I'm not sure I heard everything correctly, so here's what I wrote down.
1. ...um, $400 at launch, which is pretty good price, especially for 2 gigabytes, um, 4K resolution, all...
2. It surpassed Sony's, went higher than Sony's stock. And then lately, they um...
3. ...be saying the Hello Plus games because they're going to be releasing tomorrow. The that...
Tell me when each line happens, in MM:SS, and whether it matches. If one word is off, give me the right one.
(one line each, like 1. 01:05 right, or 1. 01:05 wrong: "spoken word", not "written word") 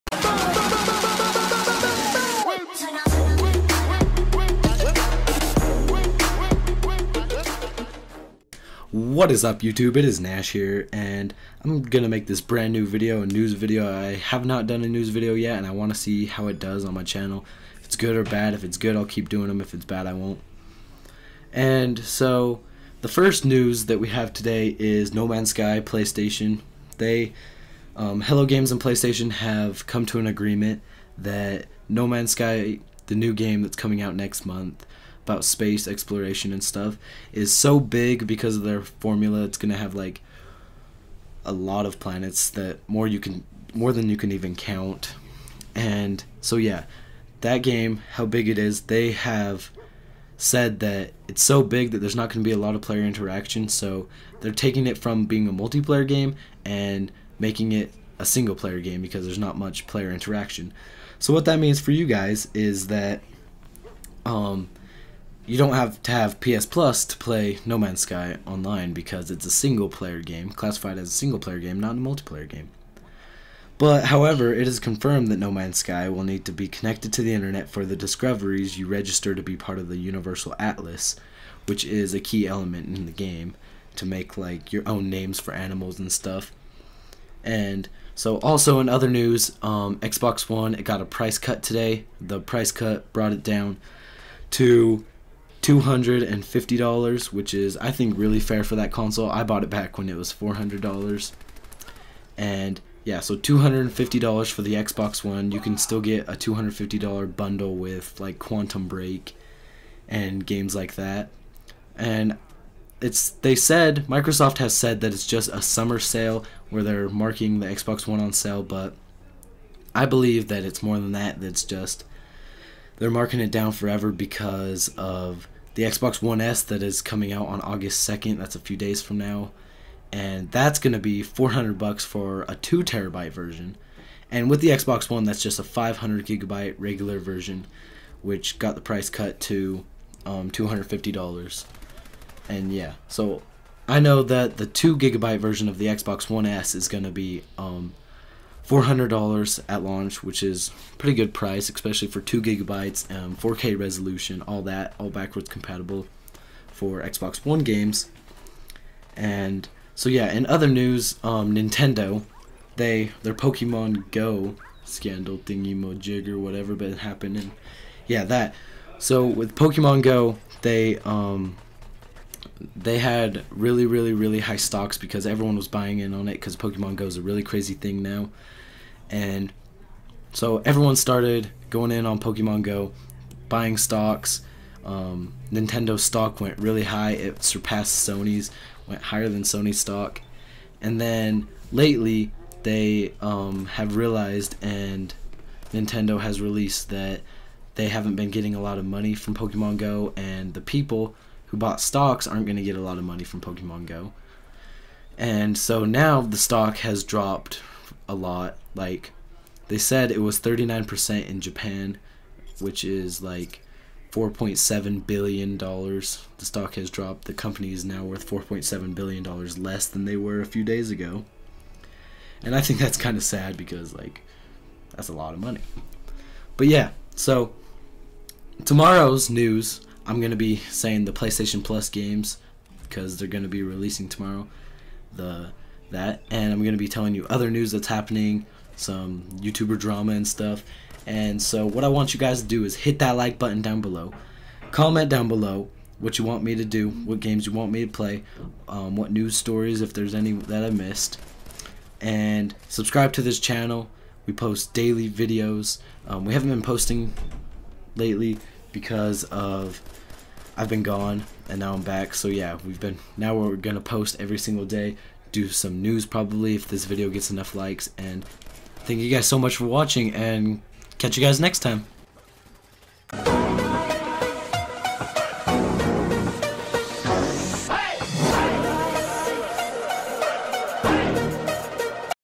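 1. 02:27 right
2. 03:07 right
3. 03:50 wrong: "PlayStation", not "Hello".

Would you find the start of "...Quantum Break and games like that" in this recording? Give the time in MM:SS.
01:48.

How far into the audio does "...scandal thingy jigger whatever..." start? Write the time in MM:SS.
02:44.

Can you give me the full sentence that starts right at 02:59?
And so everyone started going in on Pokemon Go, buying stocks.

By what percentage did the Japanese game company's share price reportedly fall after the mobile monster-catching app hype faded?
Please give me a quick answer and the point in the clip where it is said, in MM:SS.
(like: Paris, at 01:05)
39%, at 03:30.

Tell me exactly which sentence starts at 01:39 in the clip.
I bought it back when it was $400.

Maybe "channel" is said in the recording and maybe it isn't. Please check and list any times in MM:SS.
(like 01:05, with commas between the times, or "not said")
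00:17, 04:13.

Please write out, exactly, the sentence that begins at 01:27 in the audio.
And so, also in other news, um, Xbox One it got a price cut today.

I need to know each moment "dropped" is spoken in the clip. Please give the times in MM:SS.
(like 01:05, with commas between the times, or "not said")
03:27, 03:36.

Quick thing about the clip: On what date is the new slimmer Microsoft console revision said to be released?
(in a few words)
August 2nd.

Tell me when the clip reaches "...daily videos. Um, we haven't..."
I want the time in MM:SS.
04:14.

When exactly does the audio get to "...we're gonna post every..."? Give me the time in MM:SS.
04:23.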